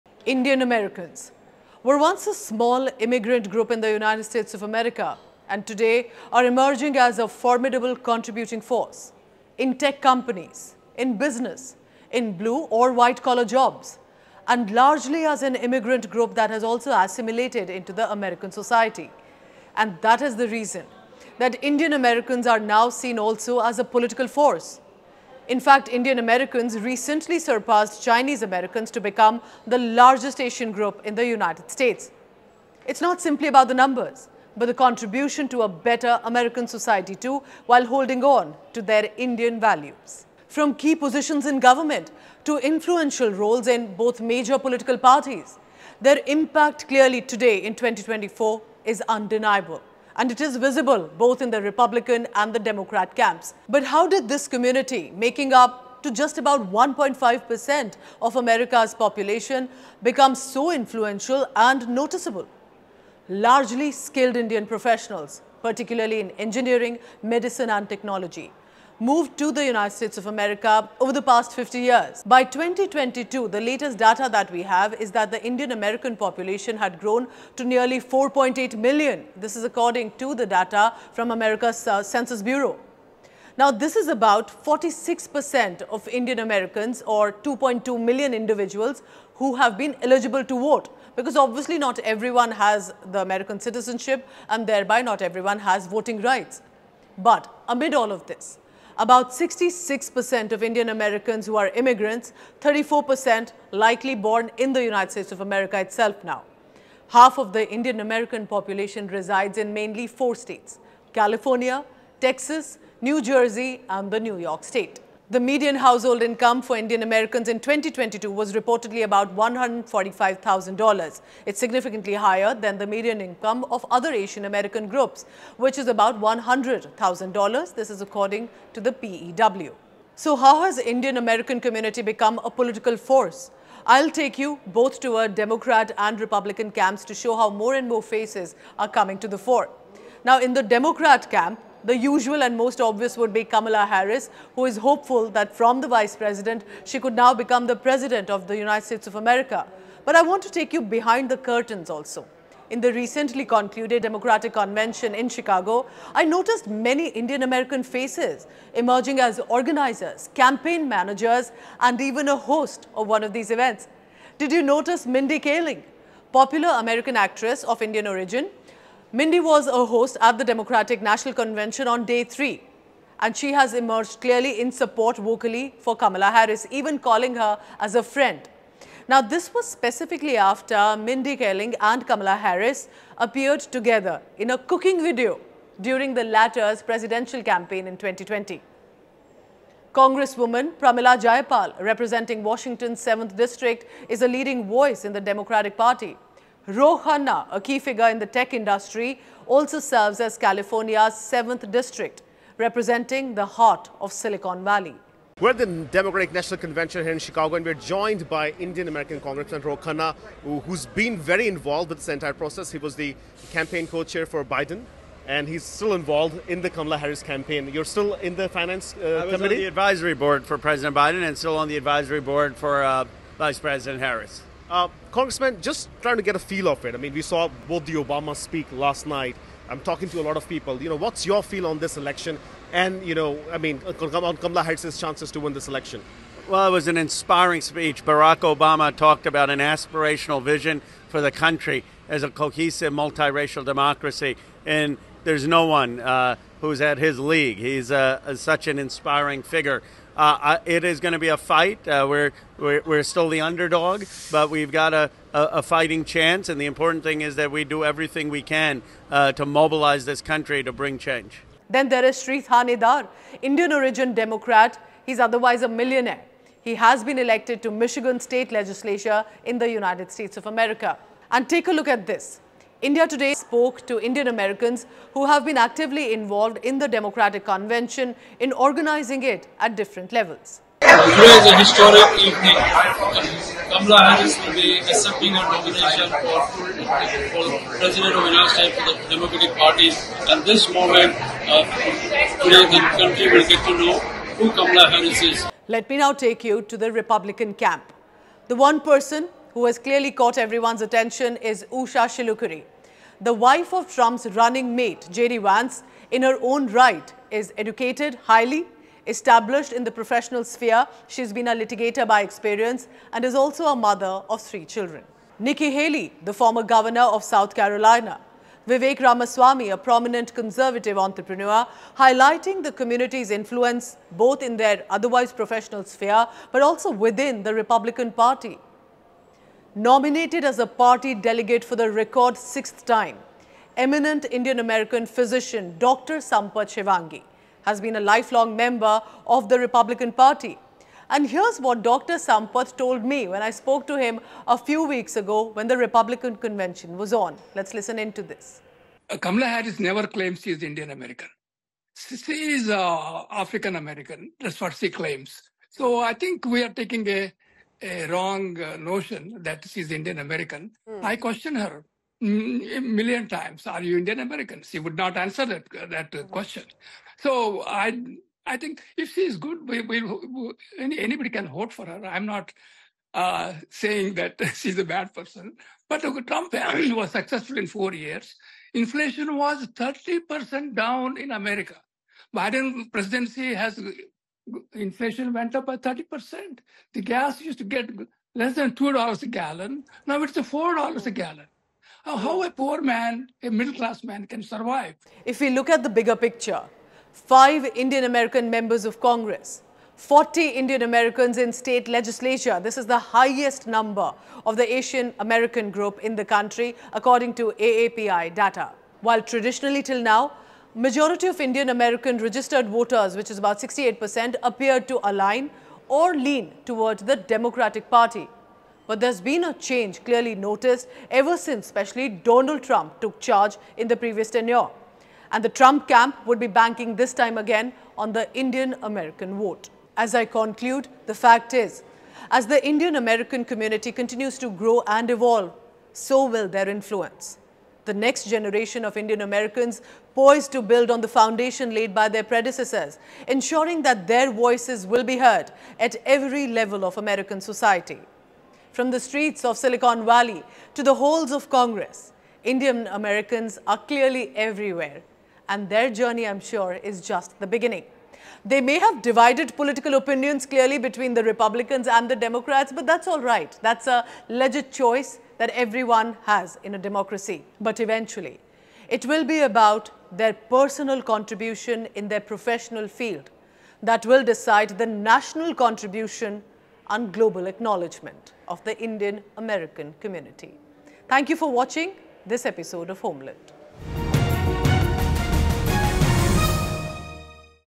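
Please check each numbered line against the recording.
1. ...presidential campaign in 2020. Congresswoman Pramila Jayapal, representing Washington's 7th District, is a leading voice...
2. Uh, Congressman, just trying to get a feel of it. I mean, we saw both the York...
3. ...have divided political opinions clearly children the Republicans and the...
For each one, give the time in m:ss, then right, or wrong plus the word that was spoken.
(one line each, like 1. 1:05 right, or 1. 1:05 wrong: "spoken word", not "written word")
1. 3:06 right
2. 3:44 wrong: "Obama", not "York"
3. 7:38 wrong: "between", not "children".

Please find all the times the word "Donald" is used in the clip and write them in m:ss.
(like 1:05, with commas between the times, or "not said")
7:02.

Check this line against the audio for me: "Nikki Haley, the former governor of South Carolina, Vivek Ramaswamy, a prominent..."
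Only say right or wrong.
right.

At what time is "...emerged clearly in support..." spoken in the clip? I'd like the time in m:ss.
2:53.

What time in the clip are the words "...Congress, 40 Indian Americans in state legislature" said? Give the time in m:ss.
6:38.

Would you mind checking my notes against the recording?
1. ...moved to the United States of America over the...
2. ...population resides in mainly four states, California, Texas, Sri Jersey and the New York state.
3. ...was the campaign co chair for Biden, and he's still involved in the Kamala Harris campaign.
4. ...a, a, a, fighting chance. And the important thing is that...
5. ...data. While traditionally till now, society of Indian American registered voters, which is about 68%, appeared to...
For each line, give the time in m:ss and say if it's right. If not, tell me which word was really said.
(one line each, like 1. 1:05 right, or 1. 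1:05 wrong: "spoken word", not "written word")
1. 1:09 right
2. 1:48 wrong: "New", not "Sri"
3. 3:32 right
4. 4:14 right
5. 6:48 wrong: "majority", not "society".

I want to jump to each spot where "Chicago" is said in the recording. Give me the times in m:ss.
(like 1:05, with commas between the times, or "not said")
2:35, 3:27.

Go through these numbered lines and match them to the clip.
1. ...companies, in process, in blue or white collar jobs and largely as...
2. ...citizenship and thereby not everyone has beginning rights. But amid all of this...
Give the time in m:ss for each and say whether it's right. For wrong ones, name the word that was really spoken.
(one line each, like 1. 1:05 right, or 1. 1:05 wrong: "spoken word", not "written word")
1. 0:10 wrong: "business", not "process"
2. 1:33 wrong: "voting", not "beginning".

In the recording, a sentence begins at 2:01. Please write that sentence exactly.
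It's significantly higher than the median income of other Asian American groups, which is about $100,000.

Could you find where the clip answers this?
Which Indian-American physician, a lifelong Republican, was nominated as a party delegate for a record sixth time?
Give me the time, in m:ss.
5:36.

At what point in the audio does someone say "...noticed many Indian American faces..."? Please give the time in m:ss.
2:36.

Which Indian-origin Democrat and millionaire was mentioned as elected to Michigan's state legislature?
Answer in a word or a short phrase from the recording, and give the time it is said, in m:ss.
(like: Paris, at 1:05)
Sri Thanedar, at 4:22.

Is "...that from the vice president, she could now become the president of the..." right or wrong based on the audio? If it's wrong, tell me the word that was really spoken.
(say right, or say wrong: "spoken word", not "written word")
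right.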